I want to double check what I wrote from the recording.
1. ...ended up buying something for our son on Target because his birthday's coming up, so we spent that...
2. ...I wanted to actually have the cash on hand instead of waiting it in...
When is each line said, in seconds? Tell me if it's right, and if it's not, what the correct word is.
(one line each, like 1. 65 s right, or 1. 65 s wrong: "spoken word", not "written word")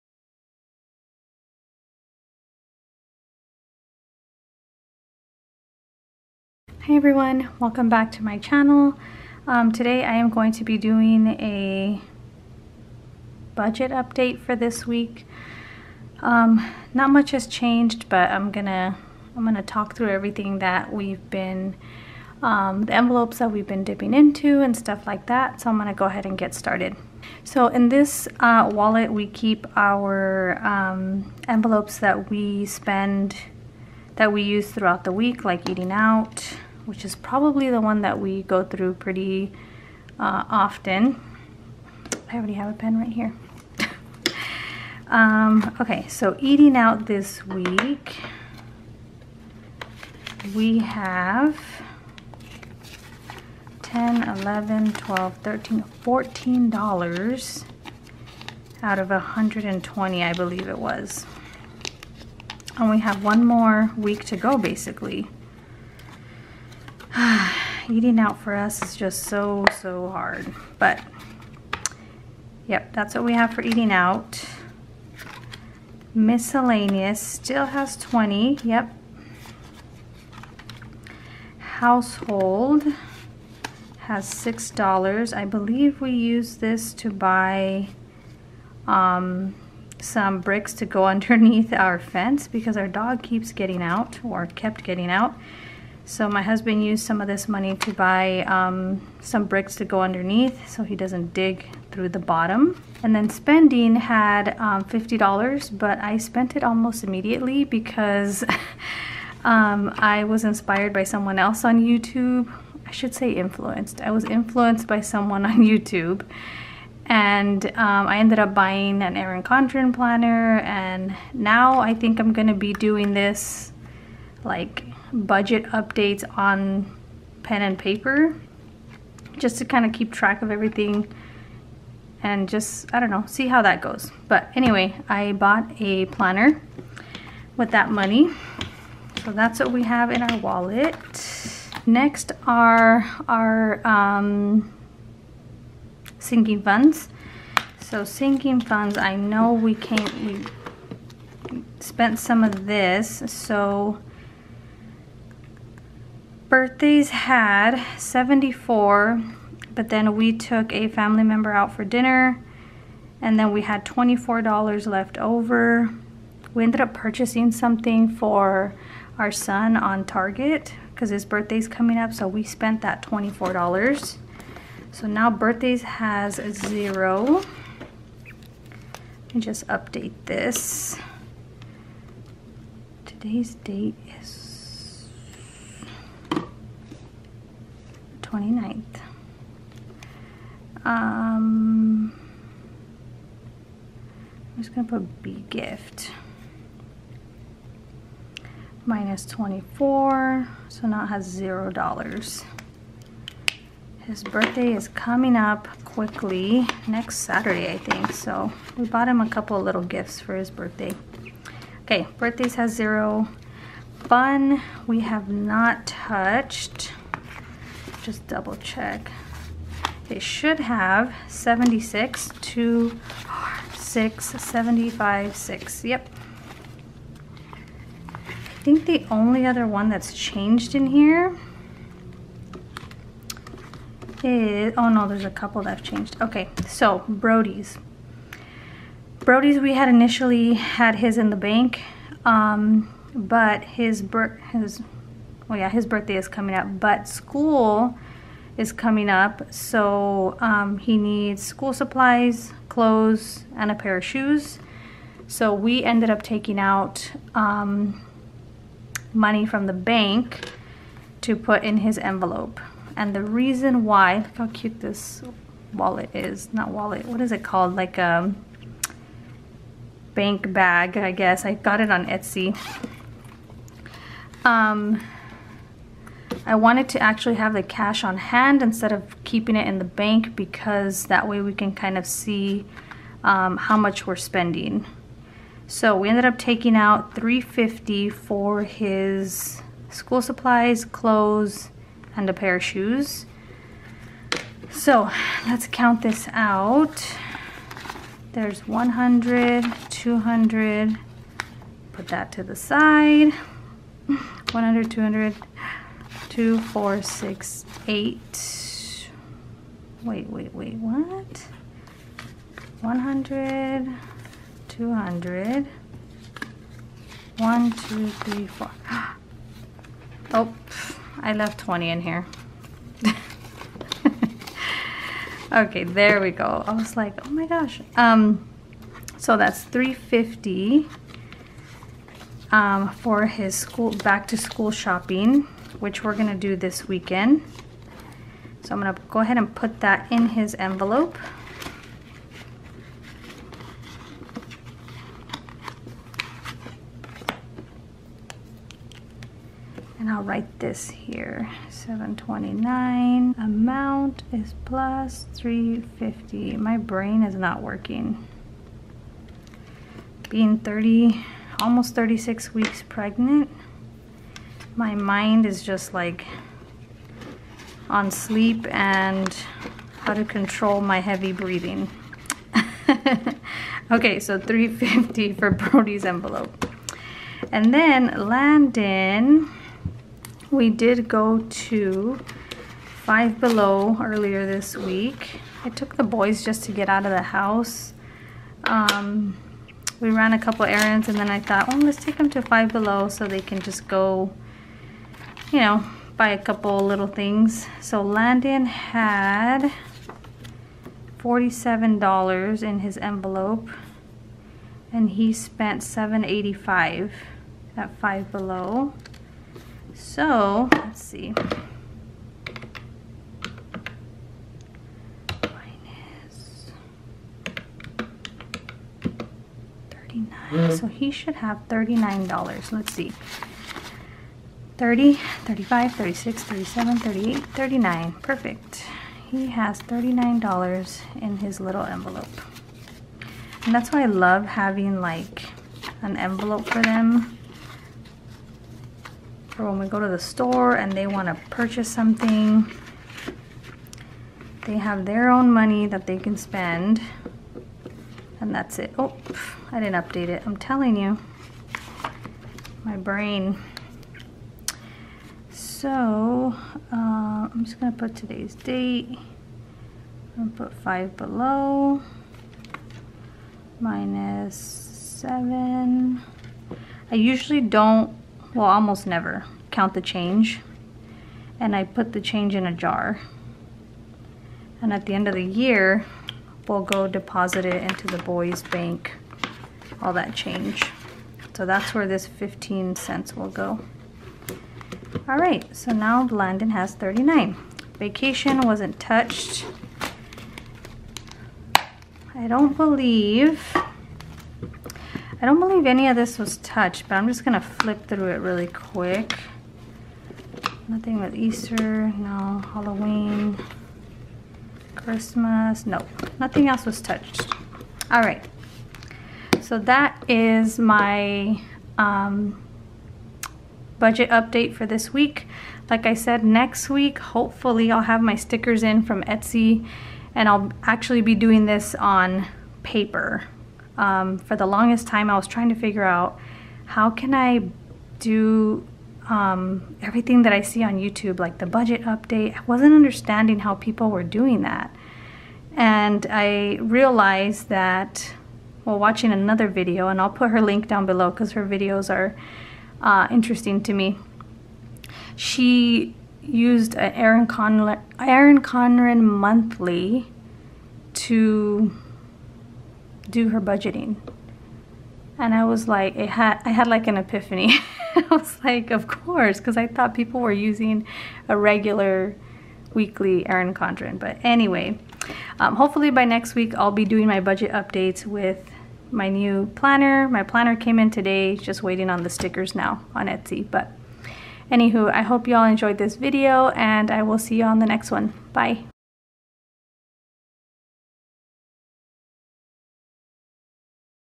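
1. 166 s wrong: "purchasing", not "buying"
2. 276 s wrong: "keeping", not "waiting".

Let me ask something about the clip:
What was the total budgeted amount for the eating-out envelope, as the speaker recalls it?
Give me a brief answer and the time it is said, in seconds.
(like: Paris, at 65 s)
120, at 59 s.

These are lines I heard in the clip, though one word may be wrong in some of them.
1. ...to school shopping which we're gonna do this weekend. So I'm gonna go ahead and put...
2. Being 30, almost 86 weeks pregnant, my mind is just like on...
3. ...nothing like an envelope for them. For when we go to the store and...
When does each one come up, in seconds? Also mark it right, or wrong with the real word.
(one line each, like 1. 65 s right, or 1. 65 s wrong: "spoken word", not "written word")
1. 334 s right
2. 360 s wrong: "36", not "86"
3. 434 s wrong: "having", not "nothing".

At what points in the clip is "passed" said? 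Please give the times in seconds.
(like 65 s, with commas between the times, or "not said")
not said.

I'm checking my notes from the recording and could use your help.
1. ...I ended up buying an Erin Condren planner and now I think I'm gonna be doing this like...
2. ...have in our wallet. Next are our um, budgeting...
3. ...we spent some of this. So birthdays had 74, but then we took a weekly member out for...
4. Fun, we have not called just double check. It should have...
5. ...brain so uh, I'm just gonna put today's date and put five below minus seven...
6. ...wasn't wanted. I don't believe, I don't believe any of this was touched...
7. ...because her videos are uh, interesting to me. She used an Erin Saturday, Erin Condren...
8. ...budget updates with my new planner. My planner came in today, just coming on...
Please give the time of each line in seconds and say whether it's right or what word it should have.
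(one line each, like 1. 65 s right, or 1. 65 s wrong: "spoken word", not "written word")
1. 118 s right
2. 139 s wrong: "sinking", not "budgeting"
3. 150 s wrong: "family", not "weekly"
4. 213 s wrong: "touched", not "called"
5. 452 s right
6. 488 s wrong: "touched", not "wanted"
7. 541 s wrong: "Condren", not "Saturday"
8. 567 s wrong: "waiting", not "coming".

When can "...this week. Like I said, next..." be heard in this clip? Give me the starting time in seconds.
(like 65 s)
514 s.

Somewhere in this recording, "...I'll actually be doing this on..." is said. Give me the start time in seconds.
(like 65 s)
520 s.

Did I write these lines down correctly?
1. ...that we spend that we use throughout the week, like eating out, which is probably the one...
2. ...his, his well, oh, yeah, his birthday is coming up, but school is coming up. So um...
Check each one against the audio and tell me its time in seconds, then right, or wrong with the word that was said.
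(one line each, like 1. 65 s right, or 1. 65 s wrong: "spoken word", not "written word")
1. 31 s right
2. 243 s right.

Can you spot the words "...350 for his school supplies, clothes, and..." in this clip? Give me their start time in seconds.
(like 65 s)
287 s.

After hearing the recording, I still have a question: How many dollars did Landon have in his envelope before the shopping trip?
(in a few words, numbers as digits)
47.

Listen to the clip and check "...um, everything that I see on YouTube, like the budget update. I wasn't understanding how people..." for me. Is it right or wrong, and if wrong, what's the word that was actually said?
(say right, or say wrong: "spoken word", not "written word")
right.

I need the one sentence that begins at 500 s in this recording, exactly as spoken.
Nothing with Easter, no, Halloween, Christmas, no, nothing else was touched.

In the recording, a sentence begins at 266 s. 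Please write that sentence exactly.
Not wallet, what is it called?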